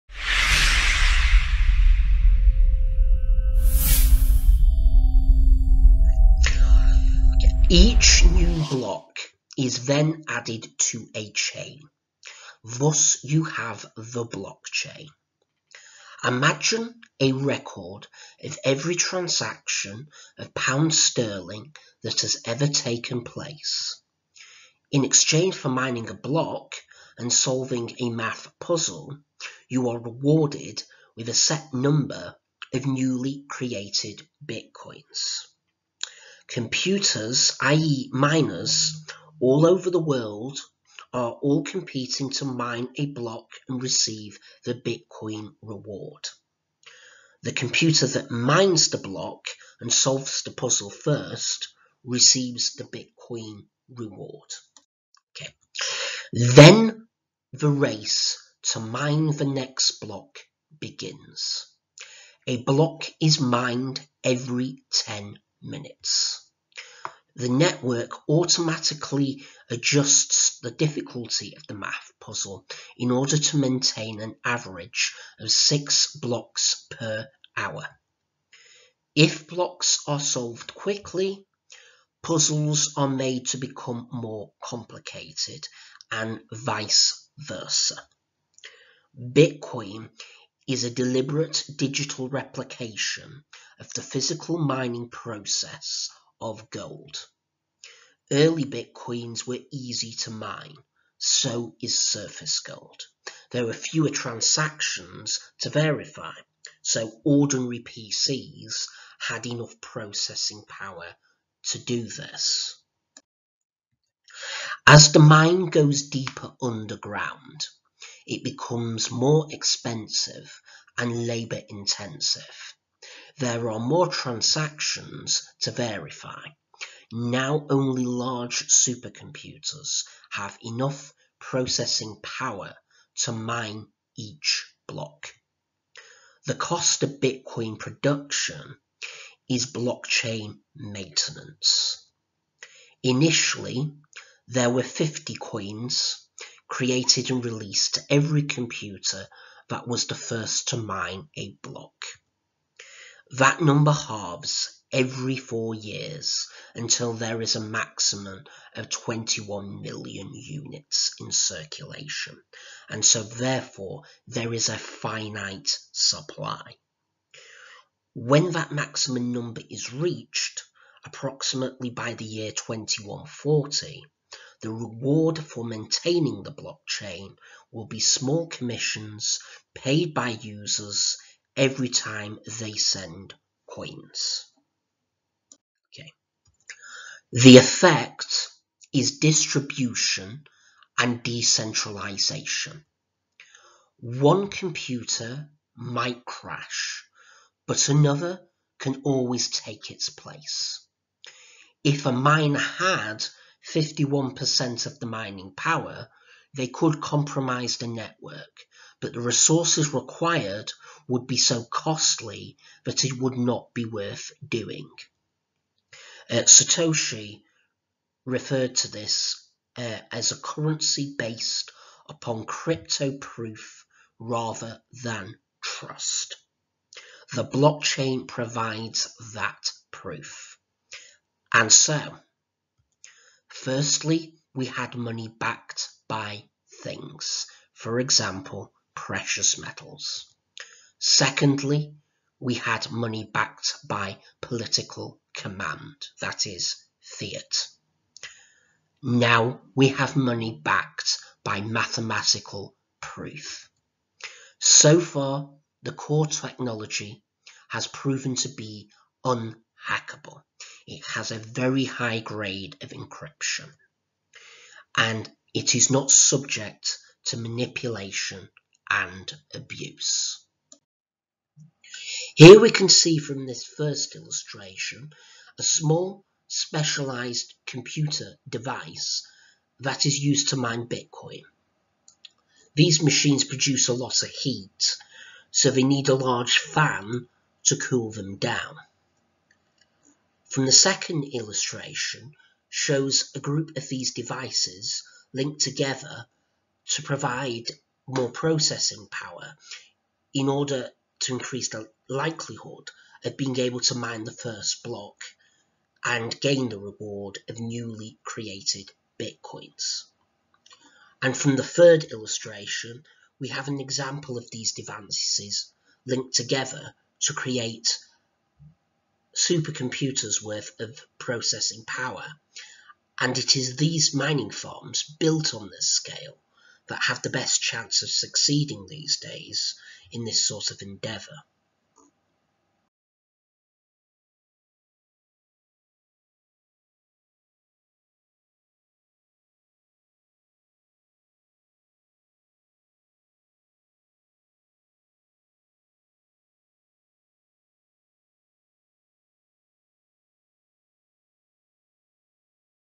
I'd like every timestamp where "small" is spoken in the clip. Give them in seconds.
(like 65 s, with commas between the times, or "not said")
178 s, 275 s.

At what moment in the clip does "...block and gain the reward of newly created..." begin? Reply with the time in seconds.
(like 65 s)
304 s.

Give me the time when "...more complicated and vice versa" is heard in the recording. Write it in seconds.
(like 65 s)
84 s.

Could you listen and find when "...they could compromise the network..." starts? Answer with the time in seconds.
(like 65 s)
206 s.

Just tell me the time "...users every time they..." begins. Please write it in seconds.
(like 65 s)
180 s.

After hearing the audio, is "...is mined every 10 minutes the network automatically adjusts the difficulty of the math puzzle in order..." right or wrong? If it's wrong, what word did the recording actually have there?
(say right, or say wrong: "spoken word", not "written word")
right.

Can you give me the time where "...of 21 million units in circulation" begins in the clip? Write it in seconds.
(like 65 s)
158 s.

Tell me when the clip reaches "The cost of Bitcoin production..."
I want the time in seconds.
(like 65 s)
136 s.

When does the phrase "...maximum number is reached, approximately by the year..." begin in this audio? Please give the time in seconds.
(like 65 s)
168 s.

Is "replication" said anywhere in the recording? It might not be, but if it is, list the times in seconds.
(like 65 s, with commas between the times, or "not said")
92 s.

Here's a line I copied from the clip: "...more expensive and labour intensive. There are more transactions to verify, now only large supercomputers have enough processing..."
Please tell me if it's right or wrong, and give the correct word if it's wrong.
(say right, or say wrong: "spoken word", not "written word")
right.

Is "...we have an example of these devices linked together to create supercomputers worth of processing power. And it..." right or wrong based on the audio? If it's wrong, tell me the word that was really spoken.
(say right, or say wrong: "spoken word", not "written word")
right.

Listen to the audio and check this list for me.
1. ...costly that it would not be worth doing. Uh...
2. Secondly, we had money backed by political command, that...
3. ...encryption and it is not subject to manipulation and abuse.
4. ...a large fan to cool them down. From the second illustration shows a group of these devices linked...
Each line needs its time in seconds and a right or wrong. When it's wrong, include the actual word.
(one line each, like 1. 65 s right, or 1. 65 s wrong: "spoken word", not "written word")
1. 211 s right
2. 240 s right
3. 262 s right
4. 286 s right.